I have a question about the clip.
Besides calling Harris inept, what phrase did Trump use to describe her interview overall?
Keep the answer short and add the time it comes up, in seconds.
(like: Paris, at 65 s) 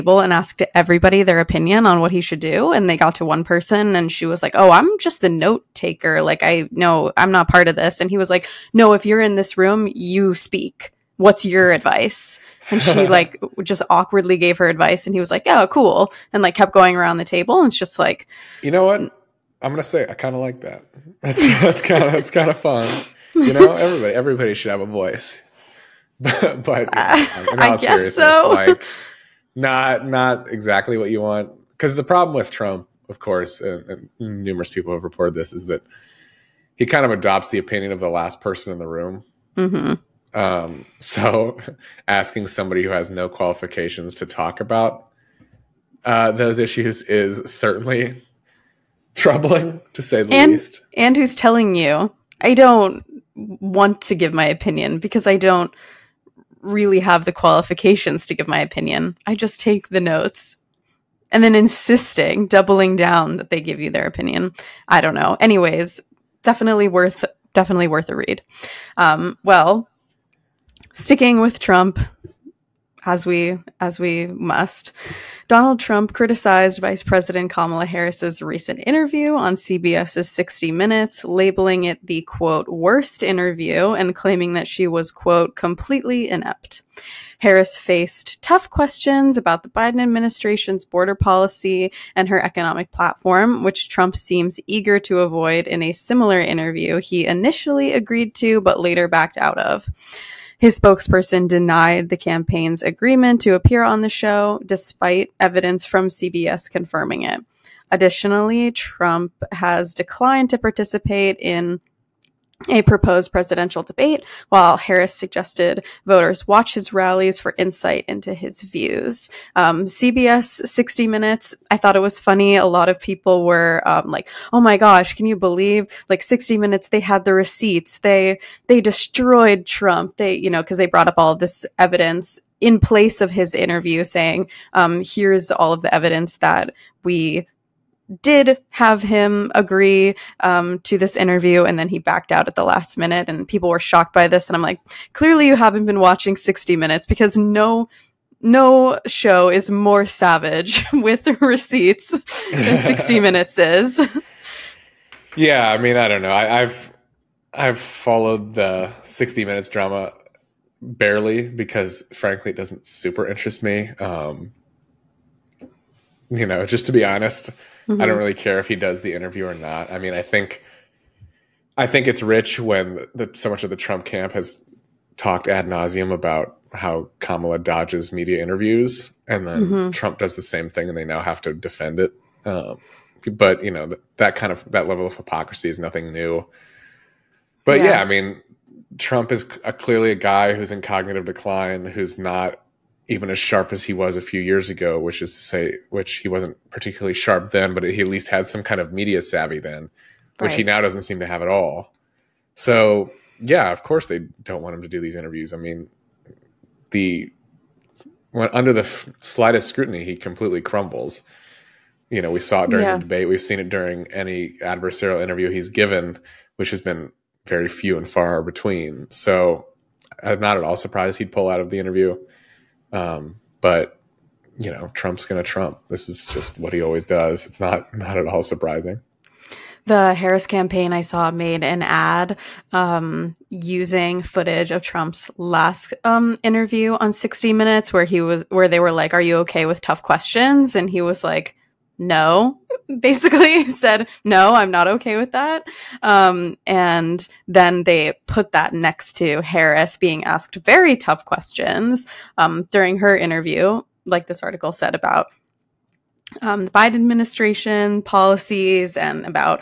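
worst interview, at 82 s.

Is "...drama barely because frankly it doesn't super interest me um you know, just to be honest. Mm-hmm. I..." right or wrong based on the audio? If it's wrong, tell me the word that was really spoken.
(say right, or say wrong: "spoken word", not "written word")
right.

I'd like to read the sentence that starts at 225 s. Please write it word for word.
This is just what he always does.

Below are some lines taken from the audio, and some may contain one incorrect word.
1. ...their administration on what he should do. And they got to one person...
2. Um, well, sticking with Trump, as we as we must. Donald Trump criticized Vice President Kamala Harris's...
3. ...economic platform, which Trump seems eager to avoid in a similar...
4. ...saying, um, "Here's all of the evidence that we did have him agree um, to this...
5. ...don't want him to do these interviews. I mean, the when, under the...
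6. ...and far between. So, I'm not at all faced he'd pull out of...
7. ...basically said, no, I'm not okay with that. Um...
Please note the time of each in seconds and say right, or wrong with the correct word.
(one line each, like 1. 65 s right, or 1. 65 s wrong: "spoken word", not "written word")
1. 1 s wrong: "opinion", not "administration"
2. 68 s right
3. 92 s right
4. 134 s right
5. 204 s right
6. 217 s wrong: "surprised", not "faced"
7. 242 s right.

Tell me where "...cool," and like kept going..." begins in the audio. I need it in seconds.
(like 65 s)
15 s.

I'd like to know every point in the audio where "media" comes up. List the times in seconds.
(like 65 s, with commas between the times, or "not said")
178 s, 198 s.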